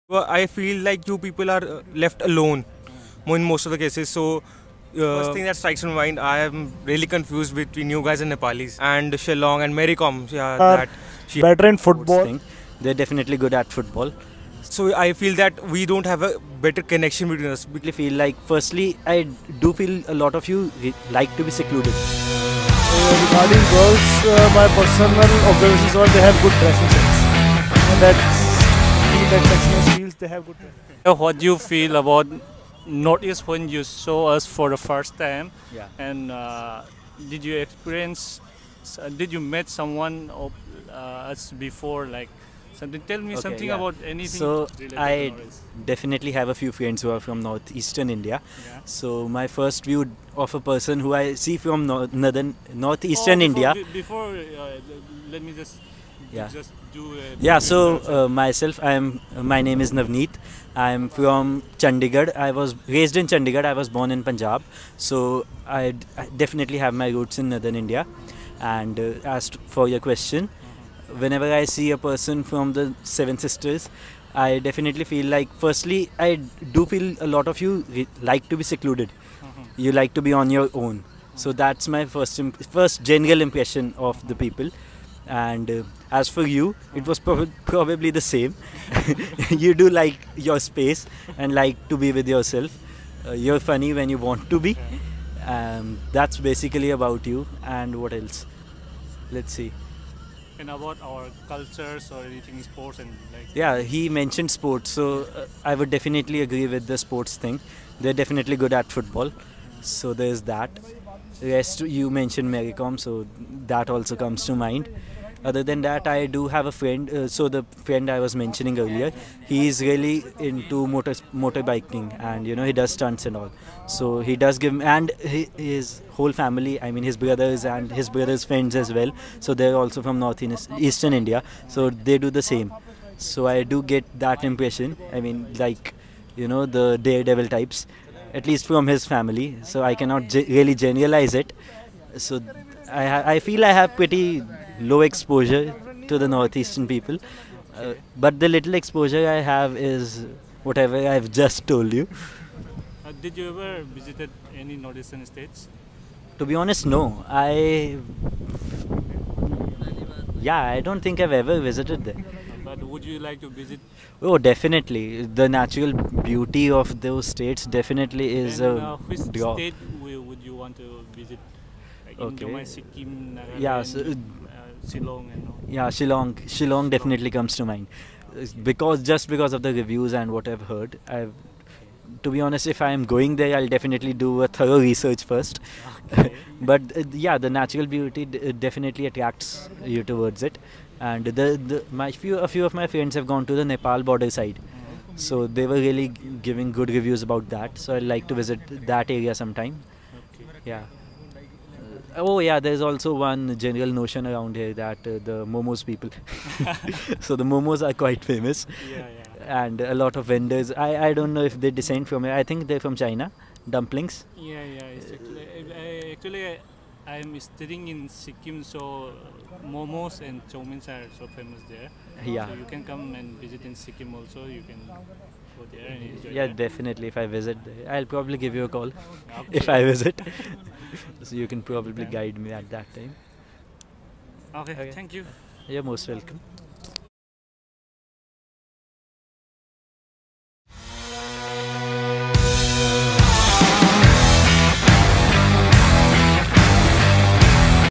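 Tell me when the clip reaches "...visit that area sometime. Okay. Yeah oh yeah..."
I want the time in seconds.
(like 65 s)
198 s.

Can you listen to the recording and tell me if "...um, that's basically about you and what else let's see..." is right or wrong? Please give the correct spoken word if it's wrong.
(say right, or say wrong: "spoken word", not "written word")
right.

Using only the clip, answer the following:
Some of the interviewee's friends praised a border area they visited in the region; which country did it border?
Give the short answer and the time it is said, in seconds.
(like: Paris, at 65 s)
Nepal, at 193 s.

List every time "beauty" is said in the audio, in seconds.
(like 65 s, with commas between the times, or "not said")
165 s, 187 s.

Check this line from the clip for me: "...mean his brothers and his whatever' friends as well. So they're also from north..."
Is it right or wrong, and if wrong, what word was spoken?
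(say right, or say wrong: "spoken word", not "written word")
wrong: "brothers", not "whatever".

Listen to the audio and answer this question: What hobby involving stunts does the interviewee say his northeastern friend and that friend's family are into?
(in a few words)
Motorbiking.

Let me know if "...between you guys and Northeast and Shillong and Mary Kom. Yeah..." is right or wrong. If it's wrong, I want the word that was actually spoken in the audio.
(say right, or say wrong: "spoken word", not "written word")
wrong: "Nepalis", not "Northeast".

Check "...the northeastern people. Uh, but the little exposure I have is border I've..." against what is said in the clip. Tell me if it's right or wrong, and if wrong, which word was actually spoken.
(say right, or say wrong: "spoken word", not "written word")
wrong: "whatever", not "border".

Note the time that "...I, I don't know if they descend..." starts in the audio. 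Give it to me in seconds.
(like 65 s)
210 s.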